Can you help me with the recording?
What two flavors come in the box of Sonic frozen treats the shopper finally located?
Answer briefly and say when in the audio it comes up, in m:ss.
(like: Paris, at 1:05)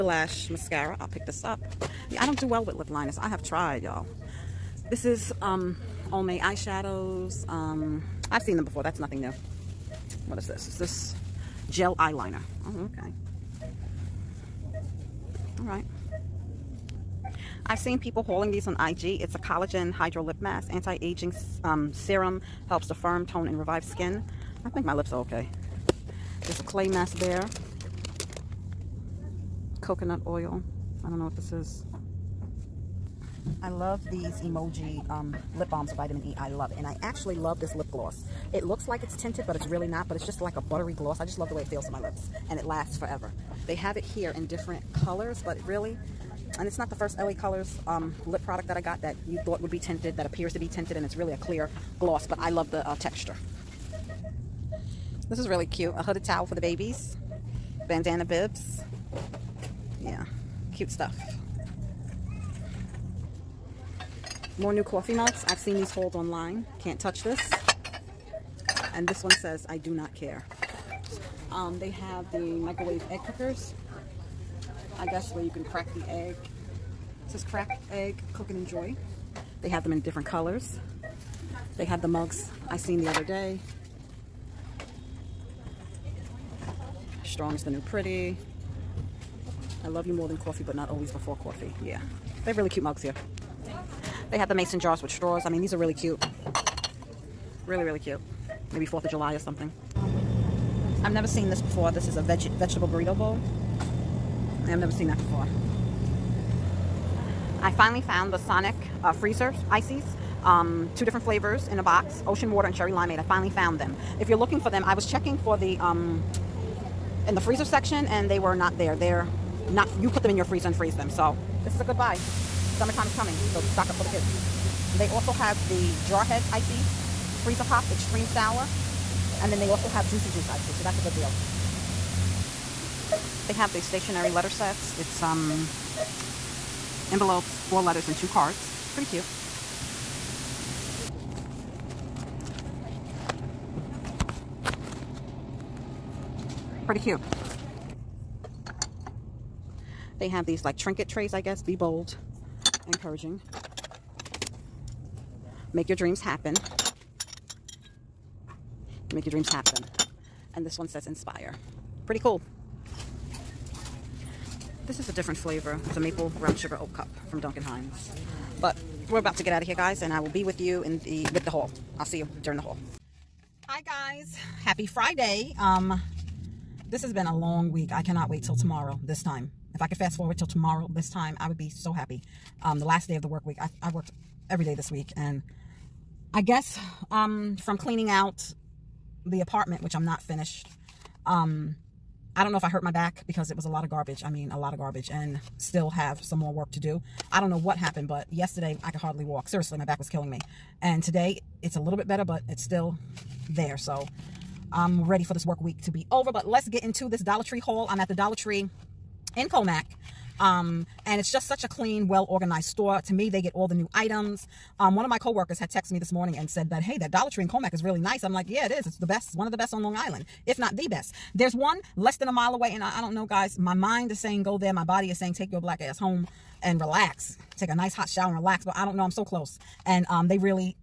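Ocean water and cherry limeade, at 1:52.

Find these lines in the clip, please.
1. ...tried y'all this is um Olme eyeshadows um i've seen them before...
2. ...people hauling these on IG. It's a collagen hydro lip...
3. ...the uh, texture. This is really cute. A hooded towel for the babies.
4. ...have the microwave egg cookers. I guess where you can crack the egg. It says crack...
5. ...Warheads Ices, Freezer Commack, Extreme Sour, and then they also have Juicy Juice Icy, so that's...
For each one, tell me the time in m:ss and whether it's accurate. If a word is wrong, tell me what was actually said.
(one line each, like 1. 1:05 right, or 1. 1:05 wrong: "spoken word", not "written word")
1. 0:03 right
2. 0:17 right
3. 0:52 right
4. 1:11 right
5. 2:06 wrong: "Pops", not "Commack".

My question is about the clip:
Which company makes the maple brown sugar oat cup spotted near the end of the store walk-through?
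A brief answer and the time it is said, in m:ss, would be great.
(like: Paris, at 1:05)
Duncan Hines, at 2:47.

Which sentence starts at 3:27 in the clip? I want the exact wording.
I'm at the Dollar Tree in Commack.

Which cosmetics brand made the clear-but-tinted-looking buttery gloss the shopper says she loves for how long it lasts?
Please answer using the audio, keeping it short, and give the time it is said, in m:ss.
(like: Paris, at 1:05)
LA Colors, at 0:47.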